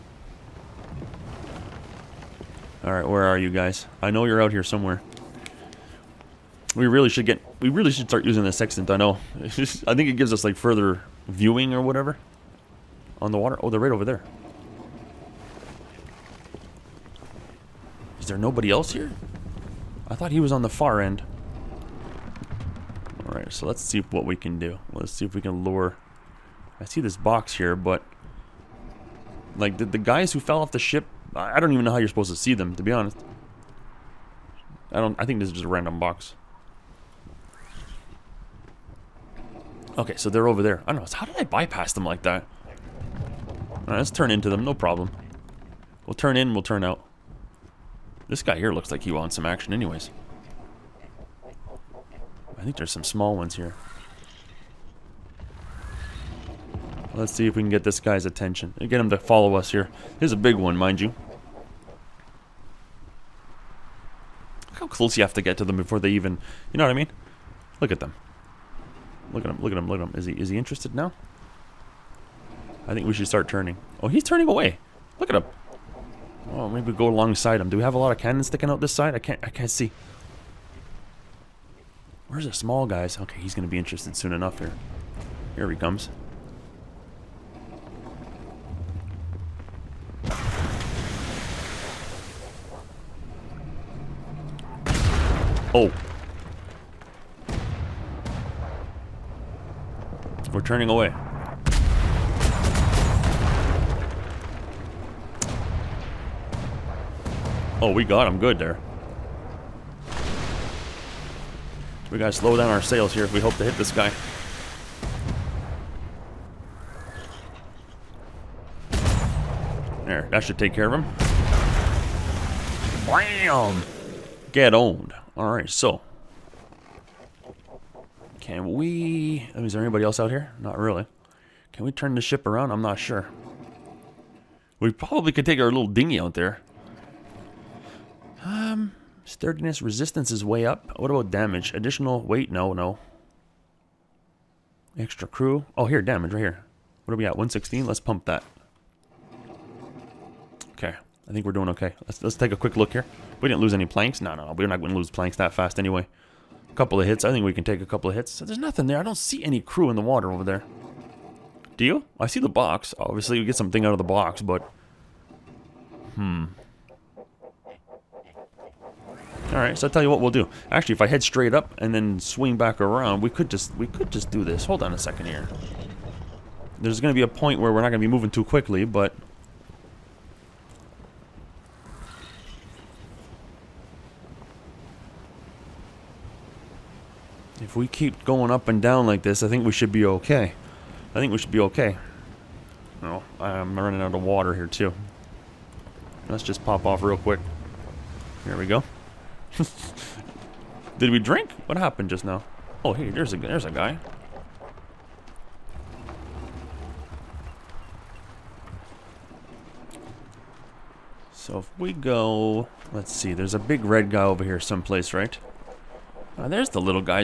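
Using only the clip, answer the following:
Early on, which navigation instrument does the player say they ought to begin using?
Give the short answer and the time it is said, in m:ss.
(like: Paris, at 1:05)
Sextant, at 0:08.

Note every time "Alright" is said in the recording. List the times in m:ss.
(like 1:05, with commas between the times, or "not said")
0:02, 0:23, 0:43, 2:05, 2:49.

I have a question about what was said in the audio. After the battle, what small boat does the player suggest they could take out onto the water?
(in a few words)
Dinghy.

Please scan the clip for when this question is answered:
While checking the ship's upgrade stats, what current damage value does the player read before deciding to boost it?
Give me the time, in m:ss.
2:27.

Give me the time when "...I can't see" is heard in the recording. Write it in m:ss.
1:19.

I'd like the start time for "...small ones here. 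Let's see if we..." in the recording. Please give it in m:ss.
0:53.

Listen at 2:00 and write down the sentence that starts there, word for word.
There, that should take care of him.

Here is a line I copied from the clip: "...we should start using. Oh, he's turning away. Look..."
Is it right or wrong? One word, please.
wrong.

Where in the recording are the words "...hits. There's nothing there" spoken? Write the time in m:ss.
2:38.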